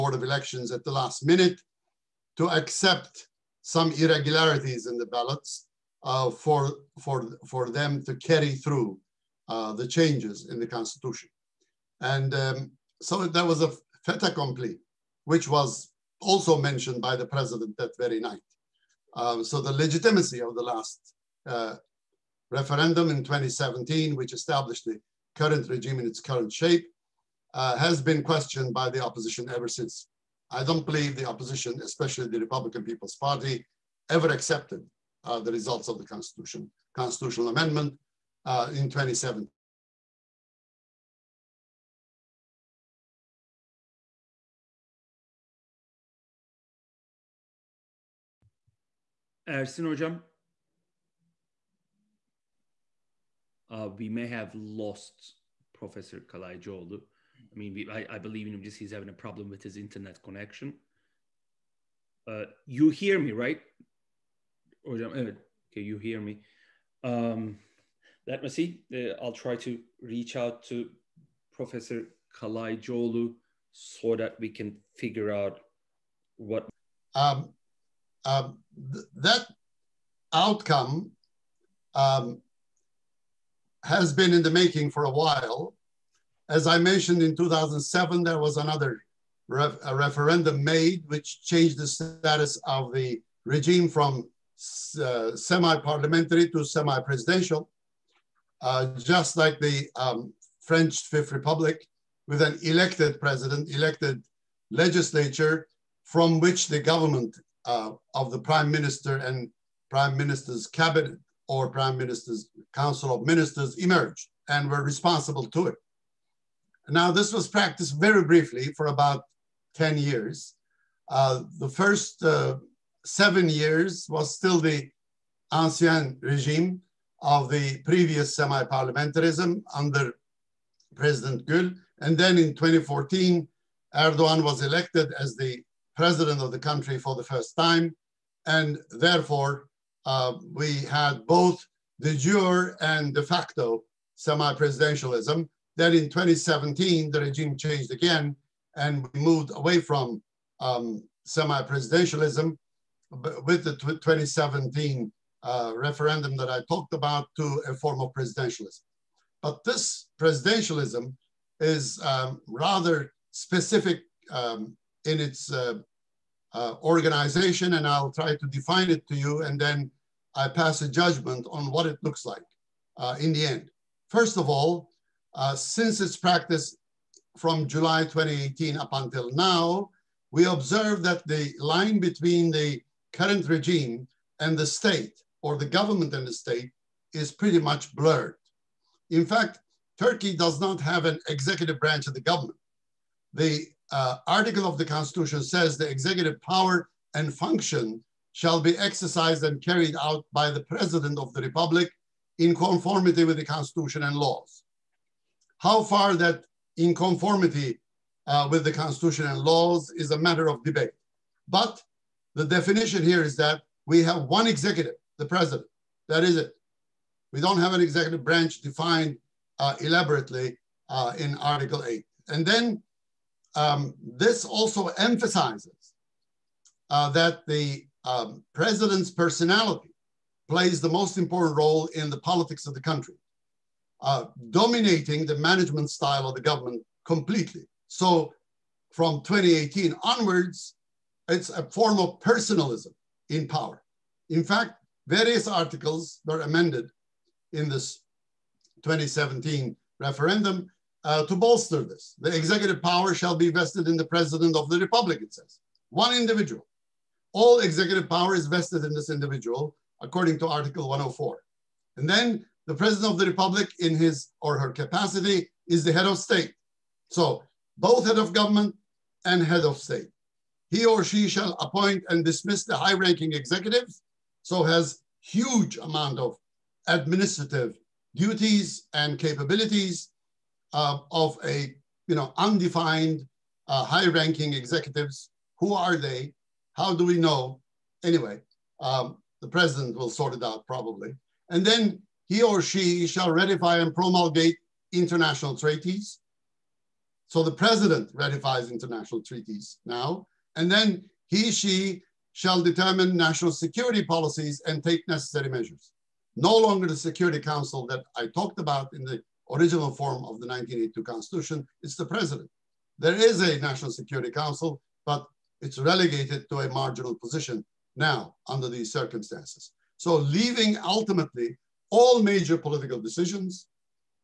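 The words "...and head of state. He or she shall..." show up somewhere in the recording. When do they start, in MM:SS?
04:29.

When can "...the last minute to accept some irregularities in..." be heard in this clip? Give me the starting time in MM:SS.
00:00.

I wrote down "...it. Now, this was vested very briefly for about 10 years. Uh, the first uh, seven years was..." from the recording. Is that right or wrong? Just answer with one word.
wrong.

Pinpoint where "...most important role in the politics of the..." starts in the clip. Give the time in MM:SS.
03:50.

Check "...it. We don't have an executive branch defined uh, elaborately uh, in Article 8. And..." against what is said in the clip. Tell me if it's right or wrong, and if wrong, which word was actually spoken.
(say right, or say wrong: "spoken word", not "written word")
right.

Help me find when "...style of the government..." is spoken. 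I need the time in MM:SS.
03:55.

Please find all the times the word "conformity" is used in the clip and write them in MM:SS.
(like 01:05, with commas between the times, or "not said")
03:22, 03:26.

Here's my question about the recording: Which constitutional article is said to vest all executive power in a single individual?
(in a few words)
Article 104.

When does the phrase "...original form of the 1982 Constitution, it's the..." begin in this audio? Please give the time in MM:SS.
05:09.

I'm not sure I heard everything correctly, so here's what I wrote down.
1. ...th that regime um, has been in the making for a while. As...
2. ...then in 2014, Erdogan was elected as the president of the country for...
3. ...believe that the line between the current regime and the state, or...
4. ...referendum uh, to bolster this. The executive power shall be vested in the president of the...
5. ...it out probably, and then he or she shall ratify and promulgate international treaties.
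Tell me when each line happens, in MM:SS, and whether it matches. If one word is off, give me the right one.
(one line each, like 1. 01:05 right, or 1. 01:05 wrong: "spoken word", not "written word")
1. 01:18 wrong: "outcome", not "regime"
2. 02:12 right
3. 03:00 wrong: "observe", not "believe"
4. 04:09 right
5. 04:50 right.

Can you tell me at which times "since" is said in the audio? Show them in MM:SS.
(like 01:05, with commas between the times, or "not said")
00:29, 02:55.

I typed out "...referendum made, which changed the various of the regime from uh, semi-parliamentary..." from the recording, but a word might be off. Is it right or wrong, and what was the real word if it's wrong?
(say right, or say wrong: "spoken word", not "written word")
wrong: "status", not "various".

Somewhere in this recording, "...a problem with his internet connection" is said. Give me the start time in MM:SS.
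00:59.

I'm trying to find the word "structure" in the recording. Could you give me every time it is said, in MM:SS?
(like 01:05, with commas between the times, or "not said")
not said.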